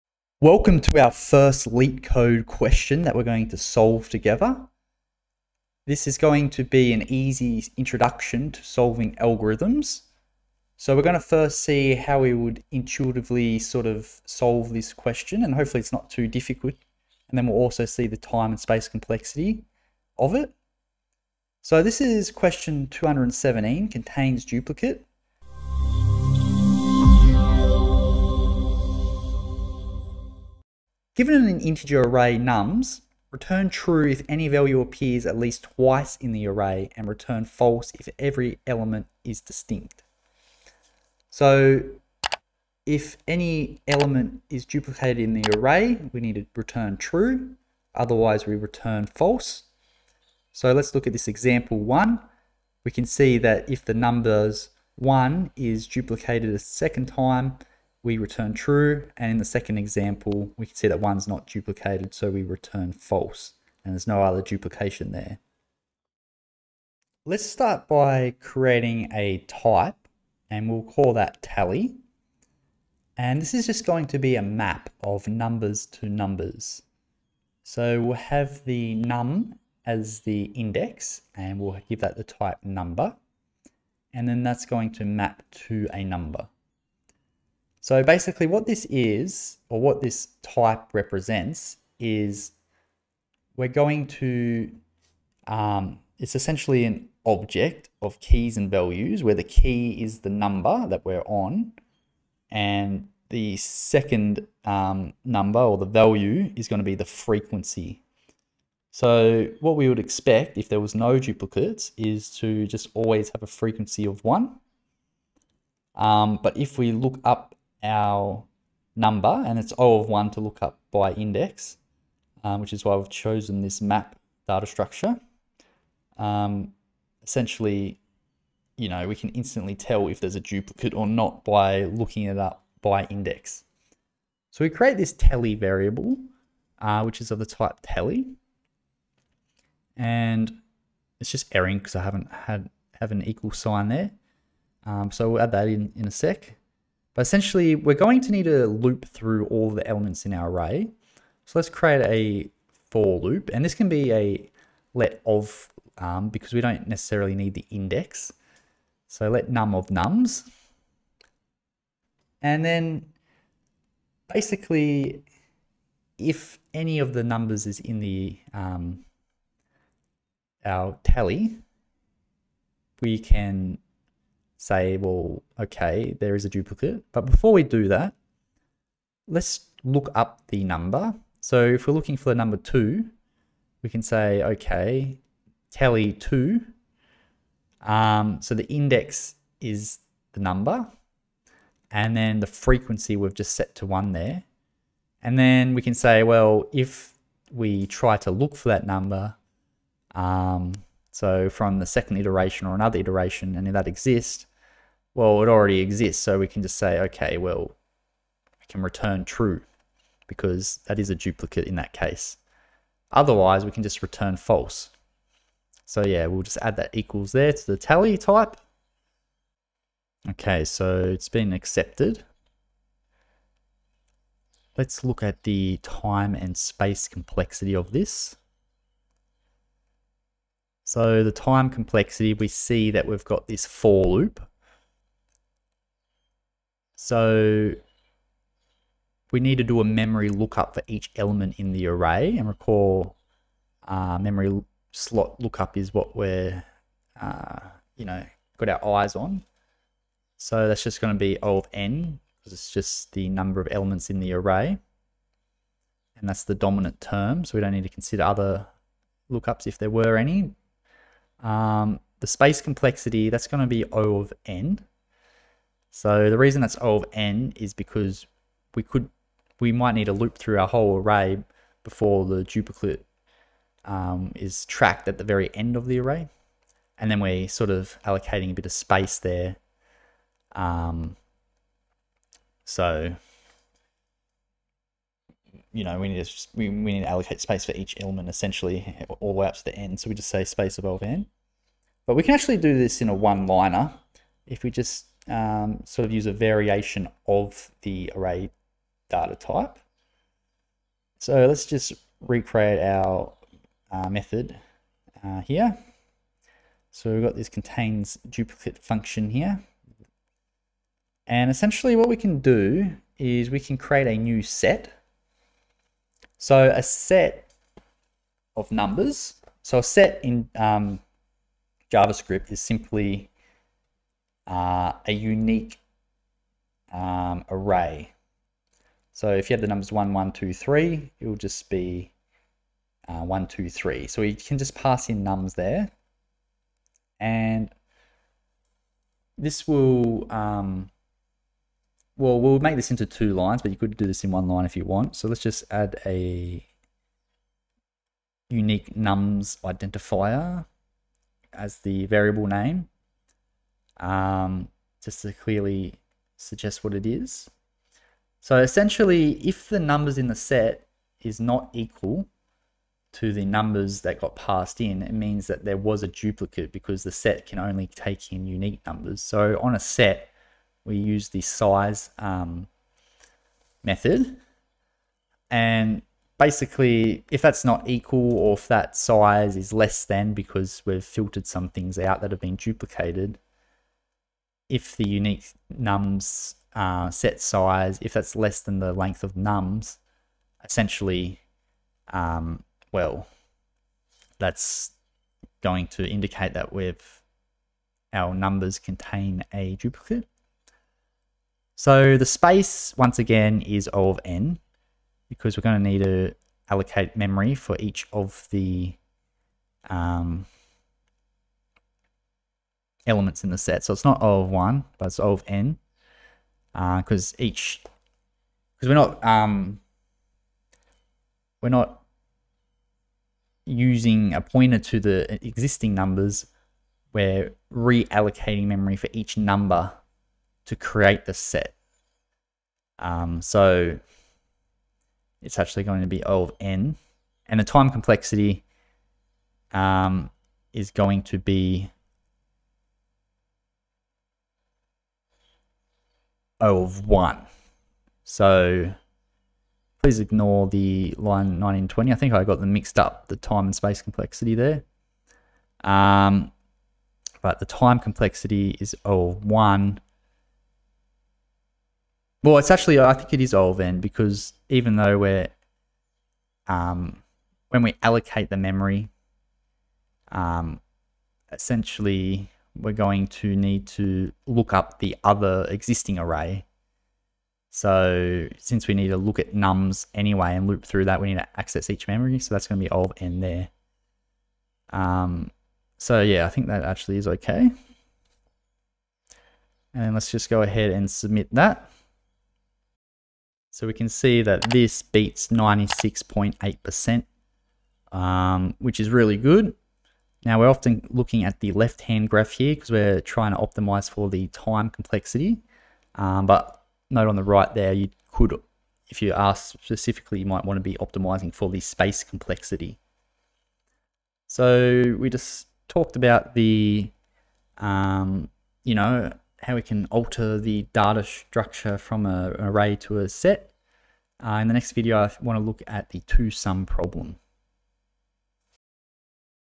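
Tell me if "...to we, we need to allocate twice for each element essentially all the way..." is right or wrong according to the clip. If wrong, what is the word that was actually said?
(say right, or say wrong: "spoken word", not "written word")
wrong: "space", not "twice".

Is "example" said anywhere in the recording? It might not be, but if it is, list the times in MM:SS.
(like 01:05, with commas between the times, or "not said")
00:51, 00:59.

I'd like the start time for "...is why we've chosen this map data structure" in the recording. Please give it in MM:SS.
02:02.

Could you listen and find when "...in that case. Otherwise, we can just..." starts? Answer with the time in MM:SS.
03:31.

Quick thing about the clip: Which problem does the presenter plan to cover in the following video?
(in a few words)
two sum.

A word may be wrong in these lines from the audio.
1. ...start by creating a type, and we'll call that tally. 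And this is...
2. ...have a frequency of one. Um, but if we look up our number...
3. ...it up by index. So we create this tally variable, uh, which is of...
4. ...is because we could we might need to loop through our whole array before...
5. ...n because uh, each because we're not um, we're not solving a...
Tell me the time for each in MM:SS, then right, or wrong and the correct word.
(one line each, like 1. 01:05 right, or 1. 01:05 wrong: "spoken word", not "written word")
1. 01:07 right
2. 01:53 right
3. 02:12 right
4. 04:27 right
5. 06:55 wrong: "using", not "solving".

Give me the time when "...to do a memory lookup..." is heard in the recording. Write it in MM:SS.
03:59.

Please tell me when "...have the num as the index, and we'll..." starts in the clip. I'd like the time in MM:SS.
01:18.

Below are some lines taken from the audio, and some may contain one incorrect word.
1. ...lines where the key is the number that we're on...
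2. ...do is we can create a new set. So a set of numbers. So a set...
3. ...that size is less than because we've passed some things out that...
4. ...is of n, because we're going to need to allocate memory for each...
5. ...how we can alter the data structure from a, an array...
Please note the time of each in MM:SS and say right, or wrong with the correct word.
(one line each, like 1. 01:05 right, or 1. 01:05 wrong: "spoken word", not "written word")
1. 01:38 wrong: "values", not "lines"
2. 05:12 right
3. 06:18 wrong: "filtered", not "passed"
4. 06:43 right
5. 08:39 right.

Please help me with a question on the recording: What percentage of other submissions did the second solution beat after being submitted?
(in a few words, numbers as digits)
96.8%.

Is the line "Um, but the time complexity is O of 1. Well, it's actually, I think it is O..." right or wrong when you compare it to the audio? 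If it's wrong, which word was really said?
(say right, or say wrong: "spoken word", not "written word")
right.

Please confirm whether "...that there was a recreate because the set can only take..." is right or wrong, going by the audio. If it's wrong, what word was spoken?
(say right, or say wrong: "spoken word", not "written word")
wrong: "duplicate", not "recreate".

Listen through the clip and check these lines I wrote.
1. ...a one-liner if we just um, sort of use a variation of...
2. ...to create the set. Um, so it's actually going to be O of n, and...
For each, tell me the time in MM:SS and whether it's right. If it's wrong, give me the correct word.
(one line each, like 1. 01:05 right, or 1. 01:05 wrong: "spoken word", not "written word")
1. 04:53 right
2. 07:10 right.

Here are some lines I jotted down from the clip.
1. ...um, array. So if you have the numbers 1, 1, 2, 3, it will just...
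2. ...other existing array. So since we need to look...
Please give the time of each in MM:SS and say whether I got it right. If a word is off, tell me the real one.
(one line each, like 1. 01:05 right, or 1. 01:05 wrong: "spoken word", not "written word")
1. 05:26 right
2. 07:55 right.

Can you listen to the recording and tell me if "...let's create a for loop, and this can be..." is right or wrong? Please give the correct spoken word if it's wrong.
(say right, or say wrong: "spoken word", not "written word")
right.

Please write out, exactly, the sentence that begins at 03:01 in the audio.
So if we're looking for the number two, we can say, okay, tally two.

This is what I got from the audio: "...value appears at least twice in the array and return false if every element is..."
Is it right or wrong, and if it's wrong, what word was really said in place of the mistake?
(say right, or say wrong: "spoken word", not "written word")
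right.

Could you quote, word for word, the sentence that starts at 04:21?
Um, the space complexity, that's going to be O of n.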